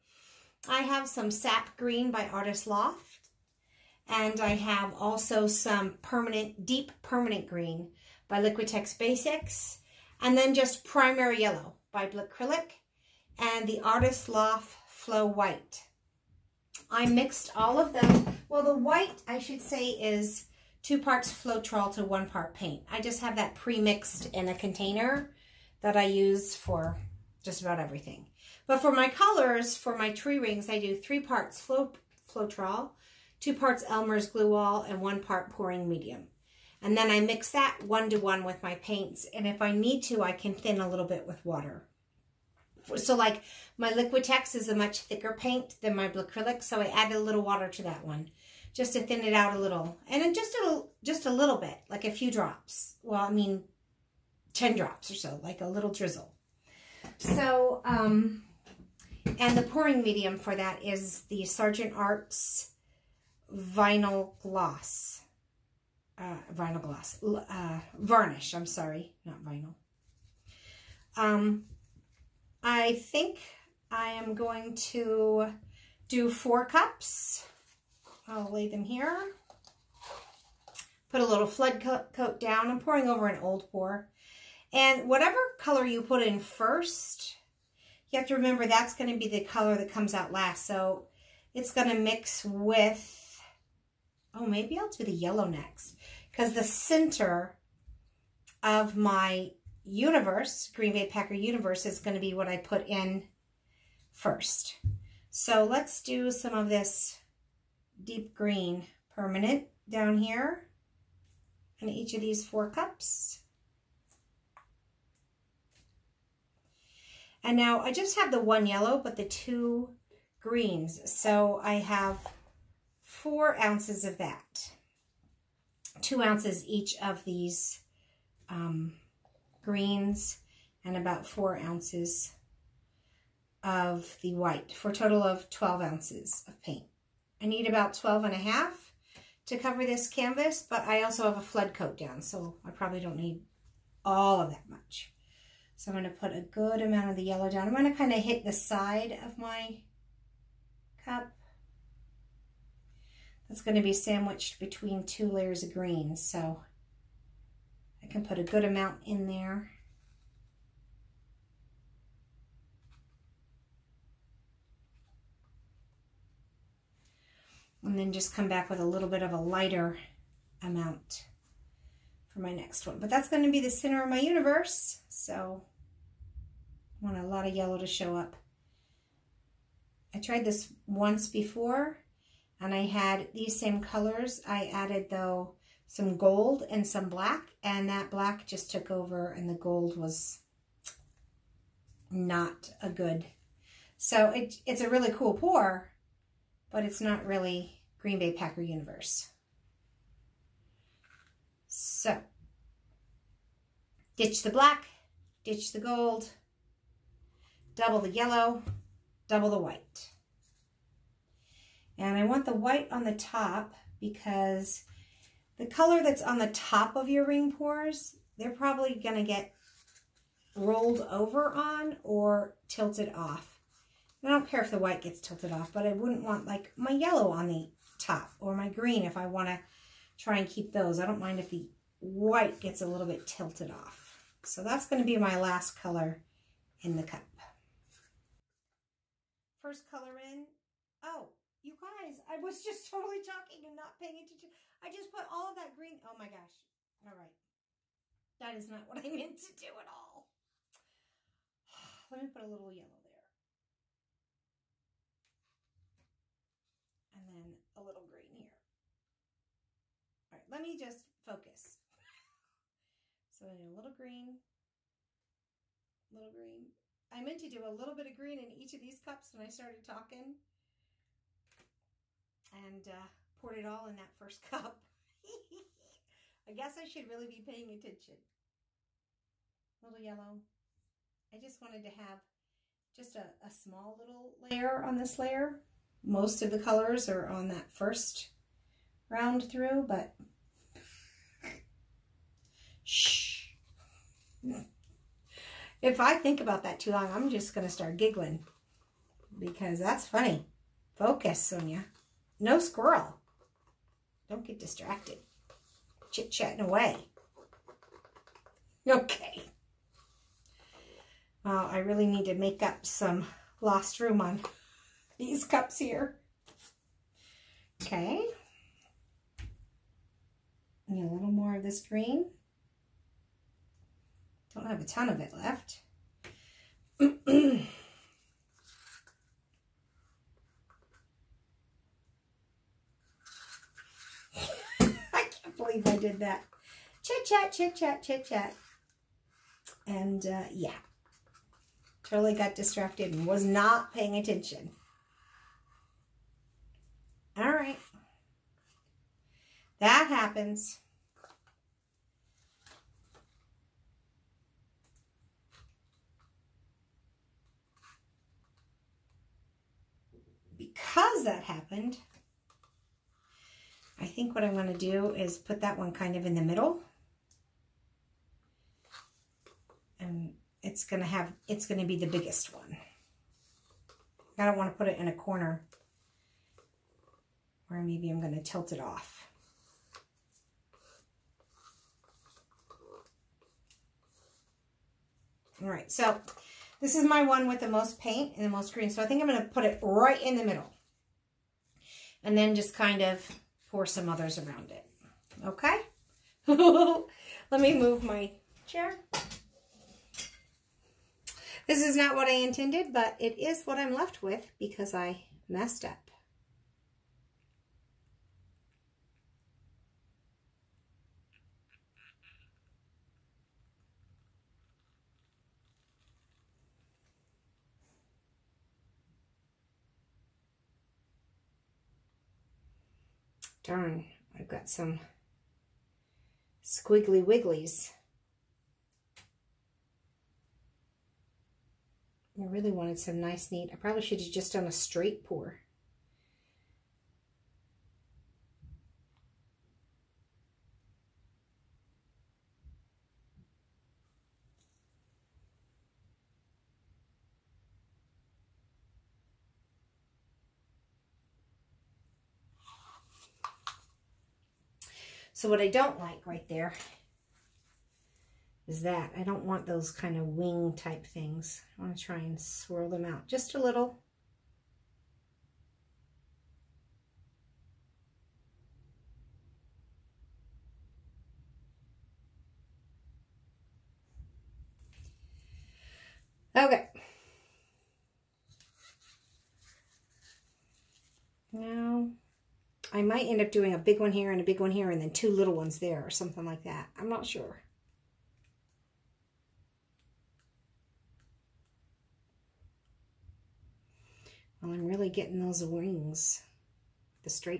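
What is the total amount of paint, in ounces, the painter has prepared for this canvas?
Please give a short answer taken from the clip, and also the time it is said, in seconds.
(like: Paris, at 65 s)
12 ounces, at 135 s.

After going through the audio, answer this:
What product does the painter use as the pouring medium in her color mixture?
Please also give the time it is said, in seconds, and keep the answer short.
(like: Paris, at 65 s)
Sargent Arts, at 61 s.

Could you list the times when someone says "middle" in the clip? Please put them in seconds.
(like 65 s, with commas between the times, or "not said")
366 s, 390 s.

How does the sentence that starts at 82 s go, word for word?
I'm pouring over an old pour.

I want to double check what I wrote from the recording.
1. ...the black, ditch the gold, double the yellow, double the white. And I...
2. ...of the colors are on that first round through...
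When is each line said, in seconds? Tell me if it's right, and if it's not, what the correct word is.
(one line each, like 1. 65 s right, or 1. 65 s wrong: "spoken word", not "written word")
1. 204 s right
2. 286 s right.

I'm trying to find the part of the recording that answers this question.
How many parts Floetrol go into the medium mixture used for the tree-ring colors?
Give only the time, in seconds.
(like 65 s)
30 s.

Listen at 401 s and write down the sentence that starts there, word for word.
This is not what I intended, but it is what I'm left with because I messed up.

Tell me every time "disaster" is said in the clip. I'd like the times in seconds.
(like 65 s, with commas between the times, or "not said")
not said.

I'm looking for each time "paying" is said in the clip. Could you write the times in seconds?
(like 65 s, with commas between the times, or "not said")
243 s, 277 s, 343 s.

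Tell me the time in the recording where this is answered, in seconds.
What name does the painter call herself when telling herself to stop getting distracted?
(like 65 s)
301 s.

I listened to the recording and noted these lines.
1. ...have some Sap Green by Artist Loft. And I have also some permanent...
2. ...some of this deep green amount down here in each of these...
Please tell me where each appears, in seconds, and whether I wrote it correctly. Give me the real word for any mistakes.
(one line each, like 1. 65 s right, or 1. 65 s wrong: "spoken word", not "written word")
1. 0 s right
2. 106 s wrong: "permanent", not "amount".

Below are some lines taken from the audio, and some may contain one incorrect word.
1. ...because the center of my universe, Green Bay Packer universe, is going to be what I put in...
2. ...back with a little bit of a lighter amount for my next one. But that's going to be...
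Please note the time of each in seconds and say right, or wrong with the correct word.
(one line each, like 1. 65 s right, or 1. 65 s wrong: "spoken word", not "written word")
1. 96 s right
2. 168 s right.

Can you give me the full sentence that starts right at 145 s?
So I'm going to put a good amount of the yellow down.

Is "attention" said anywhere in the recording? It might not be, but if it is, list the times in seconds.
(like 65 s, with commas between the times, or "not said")
244 s, 277 s, 344 s.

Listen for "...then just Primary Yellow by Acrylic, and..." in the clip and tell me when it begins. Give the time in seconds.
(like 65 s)
10 s.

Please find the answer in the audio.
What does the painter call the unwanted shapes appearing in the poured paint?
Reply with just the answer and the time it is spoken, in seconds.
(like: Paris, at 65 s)
wings, at 460 s.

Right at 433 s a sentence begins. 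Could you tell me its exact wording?
I probably should have just done a straight pour.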